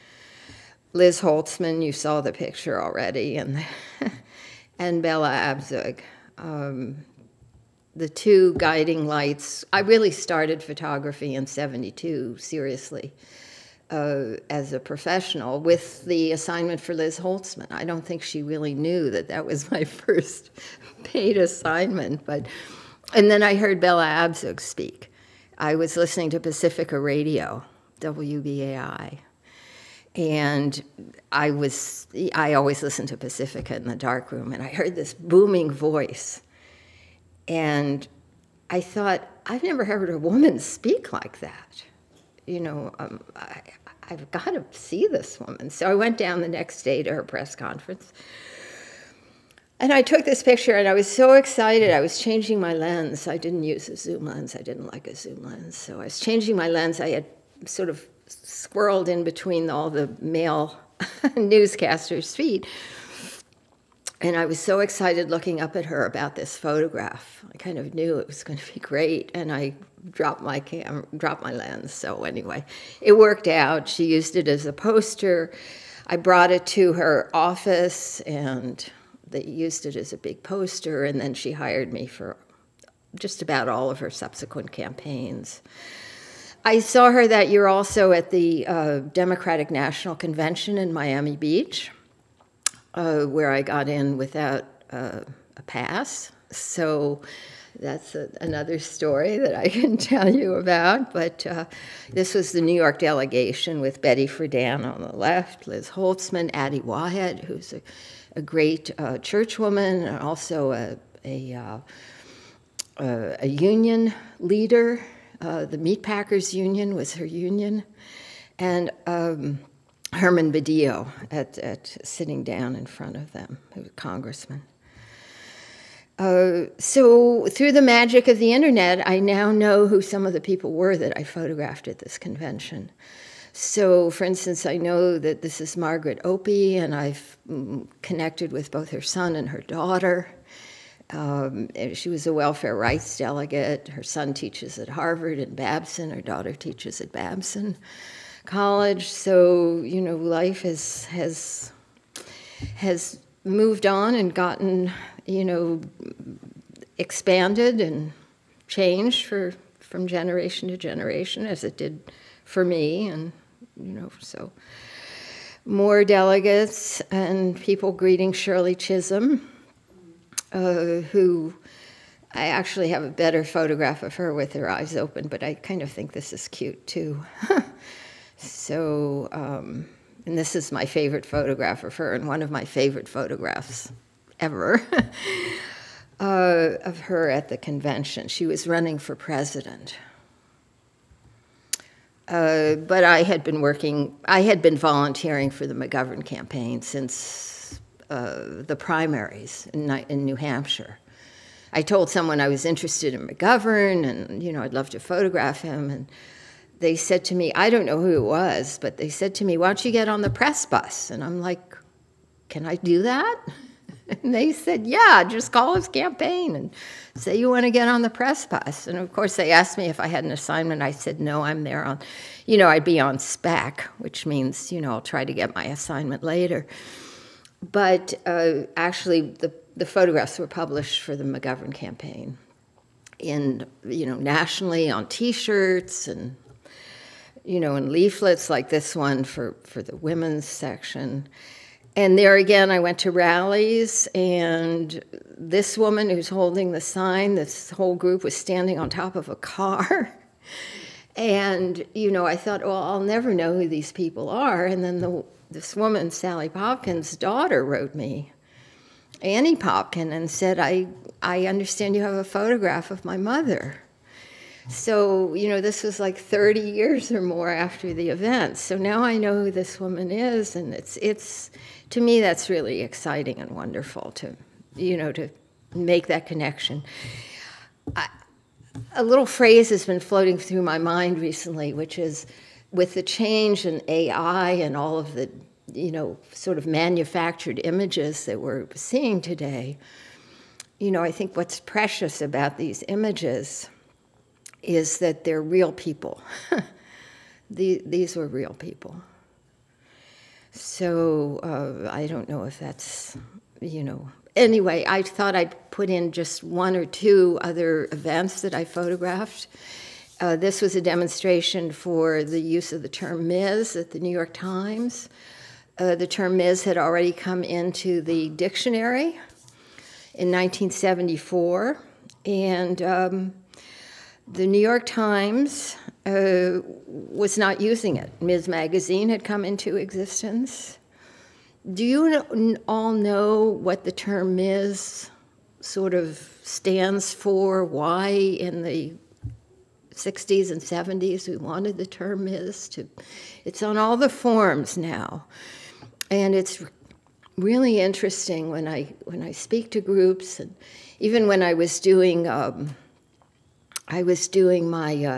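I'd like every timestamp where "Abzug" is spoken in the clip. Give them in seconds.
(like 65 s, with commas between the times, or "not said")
5 s, 24 s.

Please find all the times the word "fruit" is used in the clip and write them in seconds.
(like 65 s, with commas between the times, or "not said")
not said.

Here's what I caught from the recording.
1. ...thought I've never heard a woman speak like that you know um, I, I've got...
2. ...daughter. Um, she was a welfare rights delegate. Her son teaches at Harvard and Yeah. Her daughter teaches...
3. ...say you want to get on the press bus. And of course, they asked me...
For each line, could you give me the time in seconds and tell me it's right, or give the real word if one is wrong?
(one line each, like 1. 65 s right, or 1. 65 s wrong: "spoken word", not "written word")
1. 38 s right
2. 139 s wrong: "Babson", not "Yeah"
3. 217 s right.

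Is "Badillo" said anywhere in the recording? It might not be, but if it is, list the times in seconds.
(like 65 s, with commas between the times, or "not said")
120 s.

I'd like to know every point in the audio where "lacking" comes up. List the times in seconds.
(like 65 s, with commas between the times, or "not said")
not said.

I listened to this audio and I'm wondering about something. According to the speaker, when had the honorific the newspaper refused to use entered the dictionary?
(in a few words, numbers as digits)
1974.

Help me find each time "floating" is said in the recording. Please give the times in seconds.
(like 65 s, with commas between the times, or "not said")
279 s.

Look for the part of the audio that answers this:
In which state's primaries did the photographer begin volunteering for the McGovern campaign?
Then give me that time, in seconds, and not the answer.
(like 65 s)
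200 s.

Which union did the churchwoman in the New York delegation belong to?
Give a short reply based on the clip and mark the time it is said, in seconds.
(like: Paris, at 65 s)
Meatpackers Union, at 115 s.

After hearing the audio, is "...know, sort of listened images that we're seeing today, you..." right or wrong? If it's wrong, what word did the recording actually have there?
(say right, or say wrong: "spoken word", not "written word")
wrong: "manufactured", not "listened".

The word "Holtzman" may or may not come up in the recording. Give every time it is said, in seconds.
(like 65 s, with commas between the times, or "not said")
1 s, 17 s, 105 s.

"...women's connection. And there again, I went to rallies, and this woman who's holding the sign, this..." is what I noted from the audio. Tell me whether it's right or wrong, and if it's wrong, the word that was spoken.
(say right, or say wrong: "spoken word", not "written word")
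wrong: "section", not "connection".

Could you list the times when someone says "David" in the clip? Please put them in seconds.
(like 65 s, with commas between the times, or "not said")
not said.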